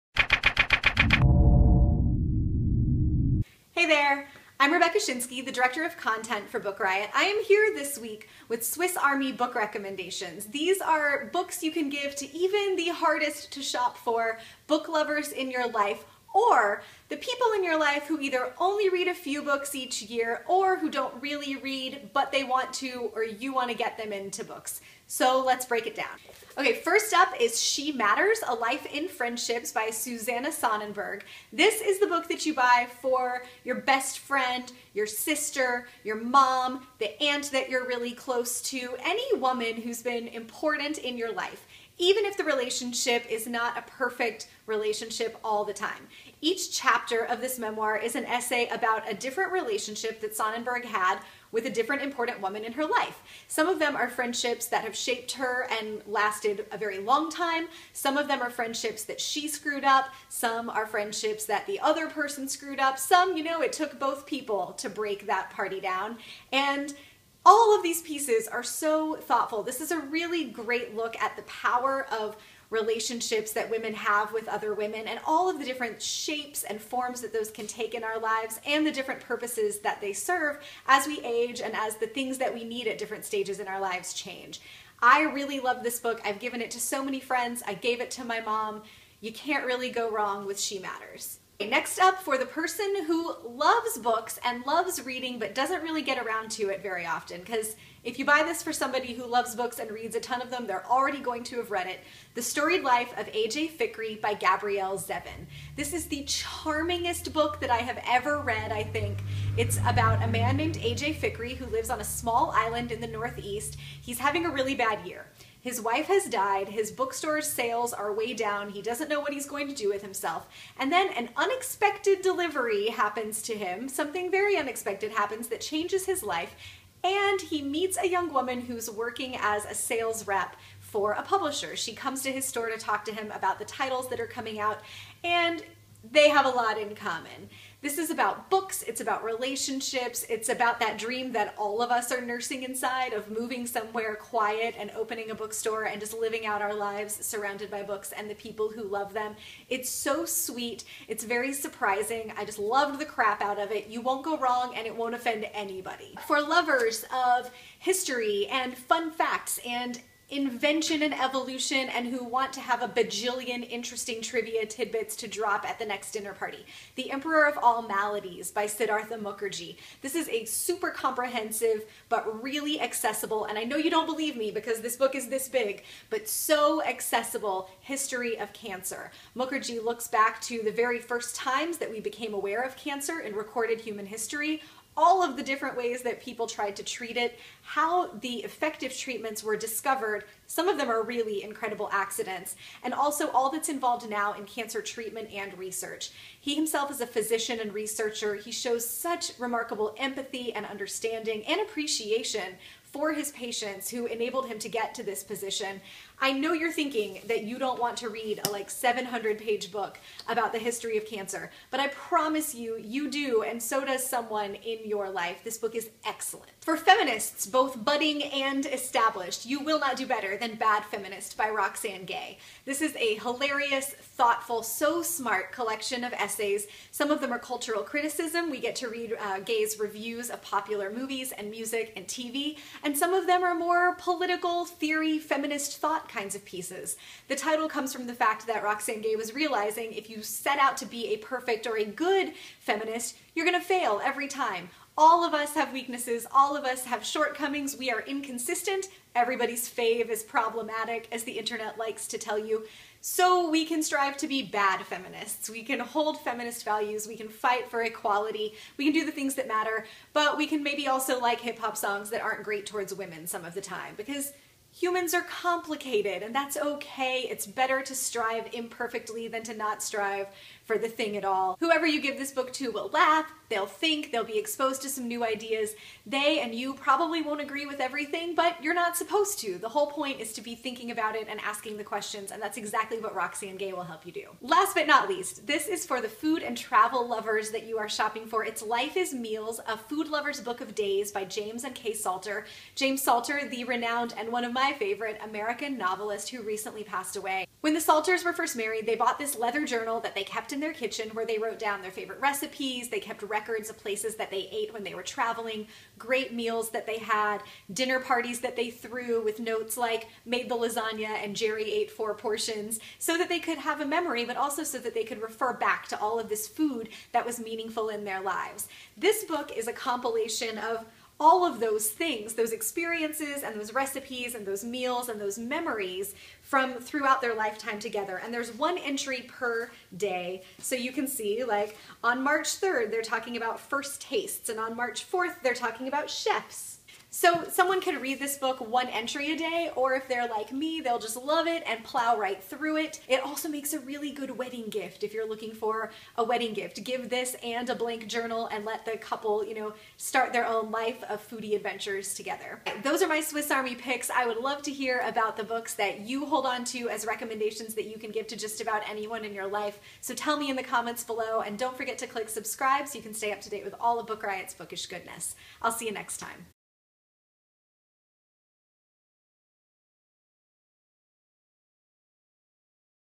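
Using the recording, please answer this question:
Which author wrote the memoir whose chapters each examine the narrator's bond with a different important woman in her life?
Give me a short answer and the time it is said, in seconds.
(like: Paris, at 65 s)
Susanna Sonnenberg, at 29 s.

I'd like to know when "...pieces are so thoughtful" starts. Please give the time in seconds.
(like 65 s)
68 s.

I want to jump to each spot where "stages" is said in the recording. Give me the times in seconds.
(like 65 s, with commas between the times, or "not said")
83 s.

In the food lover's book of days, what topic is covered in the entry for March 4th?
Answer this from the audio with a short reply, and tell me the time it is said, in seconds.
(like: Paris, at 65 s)
chefs, at 336 s.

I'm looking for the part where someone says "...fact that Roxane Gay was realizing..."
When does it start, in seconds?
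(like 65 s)
238 s.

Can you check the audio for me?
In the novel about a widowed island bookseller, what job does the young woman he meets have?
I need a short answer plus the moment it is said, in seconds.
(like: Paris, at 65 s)
sales rep for a publisher, at 129 s.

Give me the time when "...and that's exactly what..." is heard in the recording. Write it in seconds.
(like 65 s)
282 s.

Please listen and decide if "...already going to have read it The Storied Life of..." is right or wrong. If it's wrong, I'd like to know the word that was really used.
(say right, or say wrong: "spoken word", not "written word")
right.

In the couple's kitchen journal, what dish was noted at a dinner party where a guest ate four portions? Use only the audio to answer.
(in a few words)
lasagna.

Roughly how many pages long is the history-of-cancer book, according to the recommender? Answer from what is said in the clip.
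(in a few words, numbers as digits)
700.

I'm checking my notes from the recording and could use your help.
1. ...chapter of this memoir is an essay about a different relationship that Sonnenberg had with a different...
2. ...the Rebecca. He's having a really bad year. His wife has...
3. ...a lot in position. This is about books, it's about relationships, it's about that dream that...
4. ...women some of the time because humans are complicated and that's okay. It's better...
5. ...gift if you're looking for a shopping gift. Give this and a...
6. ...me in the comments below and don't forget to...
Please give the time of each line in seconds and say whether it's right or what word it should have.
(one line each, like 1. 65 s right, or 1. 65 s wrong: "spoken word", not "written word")
1. 46 s right
2. 113 s wrong: "Northeast", not "Rebecca"
3. 136 s wrong: "common", not "position"
4. 262 s right
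5. 344 s wrong: "wedding", not "shopping"
6. 360 s right.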